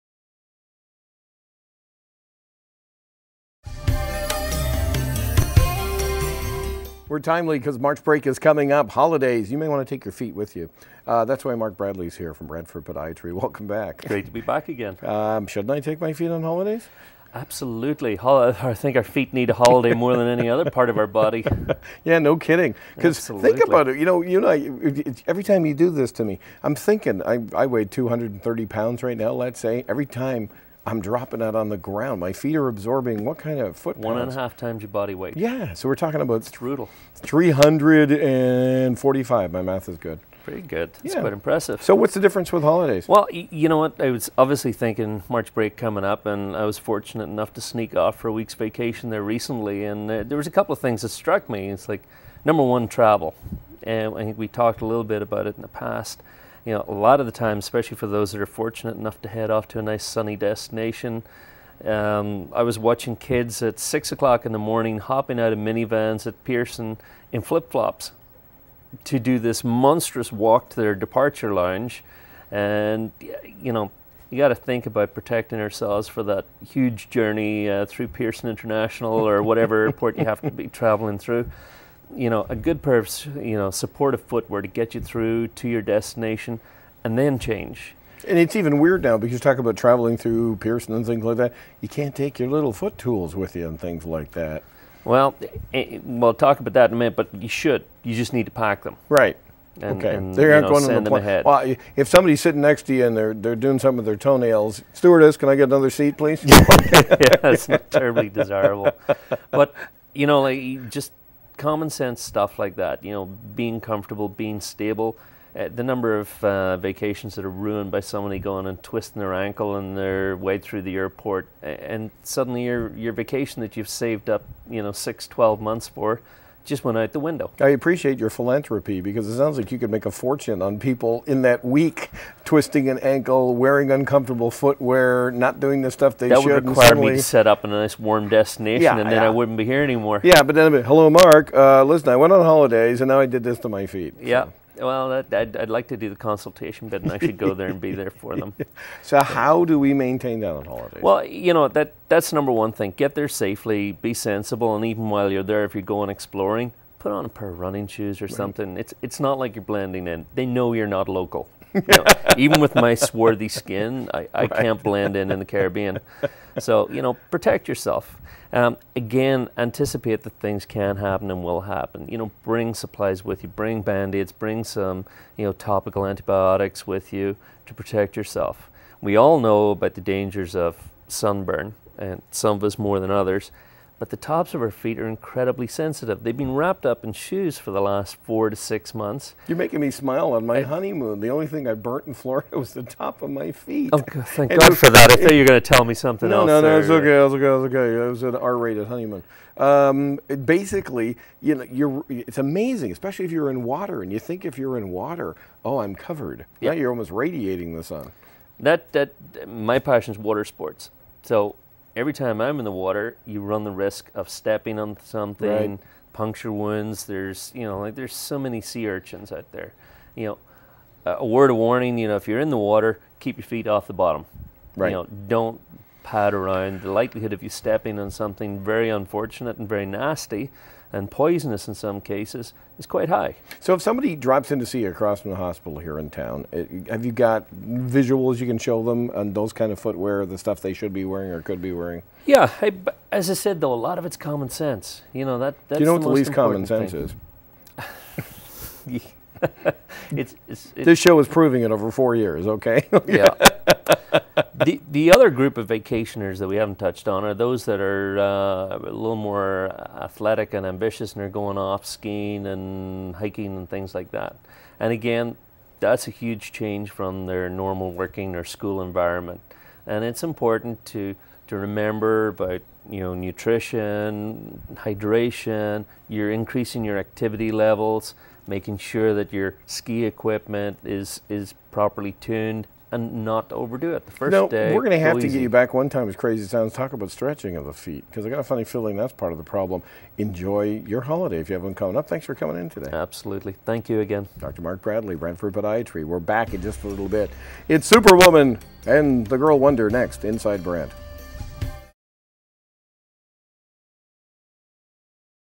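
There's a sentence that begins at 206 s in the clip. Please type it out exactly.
Yeah, you're almost radiating the sun.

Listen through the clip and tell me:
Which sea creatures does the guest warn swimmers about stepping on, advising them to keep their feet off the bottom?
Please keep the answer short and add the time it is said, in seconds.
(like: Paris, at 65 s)
sea urchins, at 218 s.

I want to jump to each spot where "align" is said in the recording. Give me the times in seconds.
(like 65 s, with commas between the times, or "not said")
not said.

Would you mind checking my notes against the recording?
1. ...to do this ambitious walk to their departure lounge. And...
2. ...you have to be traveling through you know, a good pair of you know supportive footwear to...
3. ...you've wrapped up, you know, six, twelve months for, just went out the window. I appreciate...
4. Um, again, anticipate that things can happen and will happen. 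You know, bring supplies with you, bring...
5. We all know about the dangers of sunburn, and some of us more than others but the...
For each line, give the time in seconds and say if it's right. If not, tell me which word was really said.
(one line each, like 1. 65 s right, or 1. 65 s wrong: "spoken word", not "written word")
1. 69 s wrong: "monstrous", not "ambitious"
2. 80 s right
3. 123 s wrong: "saved", not "wrapped"
4. 168 s right
5. 179 s right.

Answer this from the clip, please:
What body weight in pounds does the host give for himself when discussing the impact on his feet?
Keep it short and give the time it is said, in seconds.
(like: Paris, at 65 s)
230, at 27 s.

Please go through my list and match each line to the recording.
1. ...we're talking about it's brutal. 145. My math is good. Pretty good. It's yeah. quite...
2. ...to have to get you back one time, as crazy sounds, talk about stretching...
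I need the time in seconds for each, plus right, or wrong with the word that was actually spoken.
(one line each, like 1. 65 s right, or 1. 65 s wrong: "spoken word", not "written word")
1. 35 s wrong: "345", not "145"
2. 284 s right.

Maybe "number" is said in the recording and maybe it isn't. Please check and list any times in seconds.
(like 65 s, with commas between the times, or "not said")
52 s, 115 s, 152 s.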